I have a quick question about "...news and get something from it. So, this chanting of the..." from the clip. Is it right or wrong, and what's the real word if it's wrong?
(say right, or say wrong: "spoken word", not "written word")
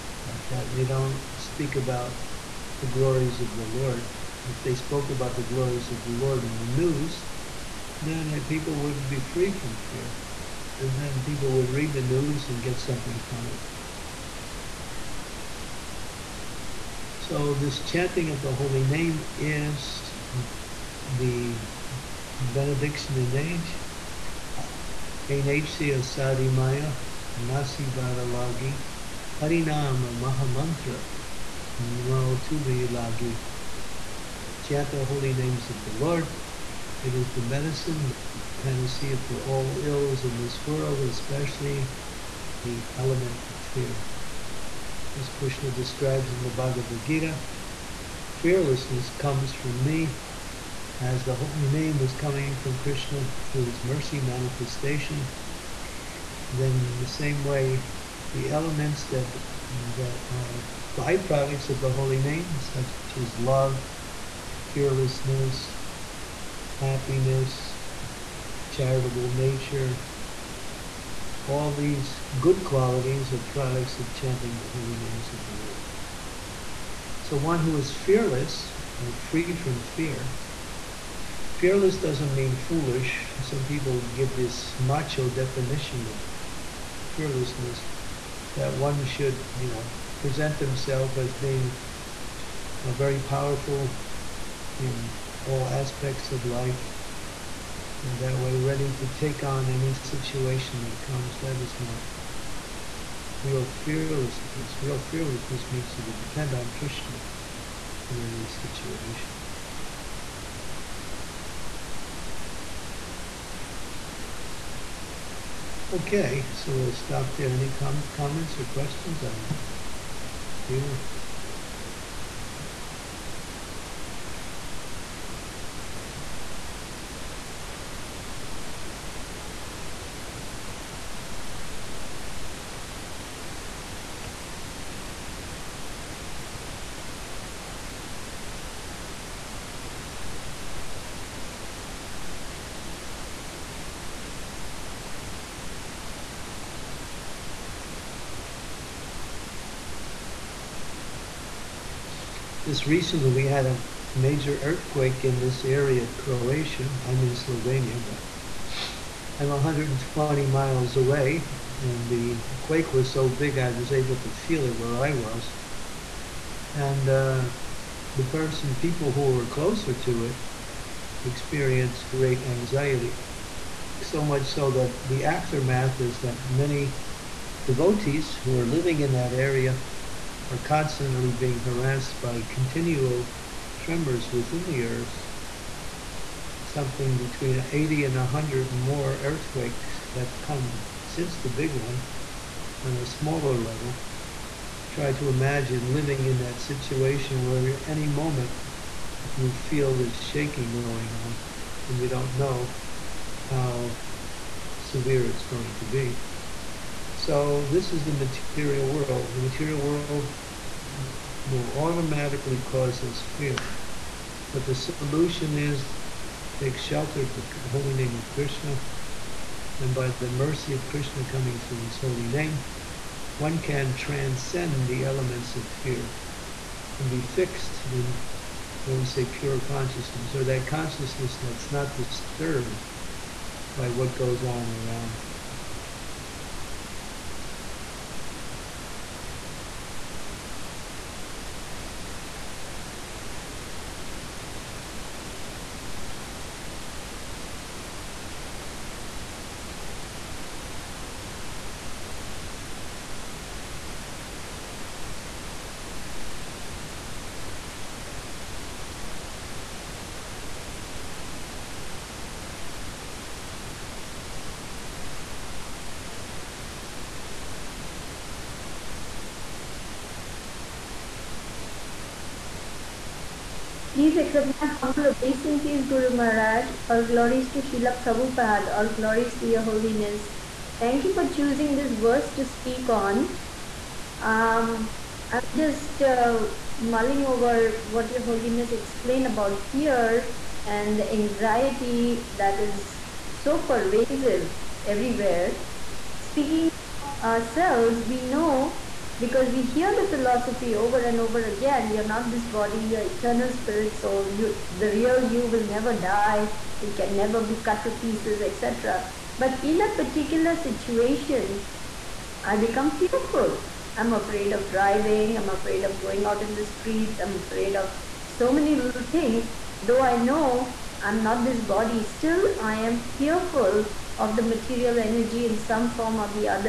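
right.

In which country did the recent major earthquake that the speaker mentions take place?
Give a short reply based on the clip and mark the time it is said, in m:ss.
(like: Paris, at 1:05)
Croatia, at 2:36.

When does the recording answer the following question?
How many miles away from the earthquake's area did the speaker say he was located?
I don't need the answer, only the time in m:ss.
2:39.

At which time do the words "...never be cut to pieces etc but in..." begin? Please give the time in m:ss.
5:07.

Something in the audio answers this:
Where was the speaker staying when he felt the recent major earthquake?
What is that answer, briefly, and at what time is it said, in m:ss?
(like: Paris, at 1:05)
Slovenia, at 2:37.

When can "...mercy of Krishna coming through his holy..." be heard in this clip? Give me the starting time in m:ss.
3:40.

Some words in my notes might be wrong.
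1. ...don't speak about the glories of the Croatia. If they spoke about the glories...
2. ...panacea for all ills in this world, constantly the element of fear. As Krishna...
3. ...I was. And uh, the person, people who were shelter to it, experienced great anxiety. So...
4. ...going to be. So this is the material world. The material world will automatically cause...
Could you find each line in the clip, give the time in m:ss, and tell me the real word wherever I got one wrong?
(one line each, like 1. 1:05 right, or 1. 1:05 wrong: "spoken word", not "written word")
1. 0:00 wrong: "Lord", not "Croatia"
2. 0:38 wrong: "especially", not "constantly"
3. 2:45 wrong: "closer", not "shelter"
4. 3:25 right.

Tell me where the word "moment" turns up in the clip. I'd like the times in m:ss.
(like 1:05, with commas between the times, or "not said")
3:18.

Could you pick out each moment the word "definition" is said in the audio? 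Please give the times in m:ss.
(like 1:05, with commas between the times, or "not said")
1:25.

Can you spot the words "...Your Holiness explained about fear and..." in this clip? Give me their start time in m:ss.
4:48.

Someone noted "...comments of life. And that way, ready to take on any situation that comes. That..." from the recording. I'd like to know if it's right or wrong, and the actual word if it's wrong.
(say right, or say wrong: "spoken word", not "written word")
wrong: "aspects", not "comments".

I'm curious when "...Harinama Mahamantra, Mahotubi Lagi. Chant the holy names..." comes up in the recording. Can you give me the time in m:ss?
0:29.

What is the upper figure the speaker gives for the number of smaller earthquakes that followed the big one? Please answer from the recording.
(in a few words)
100.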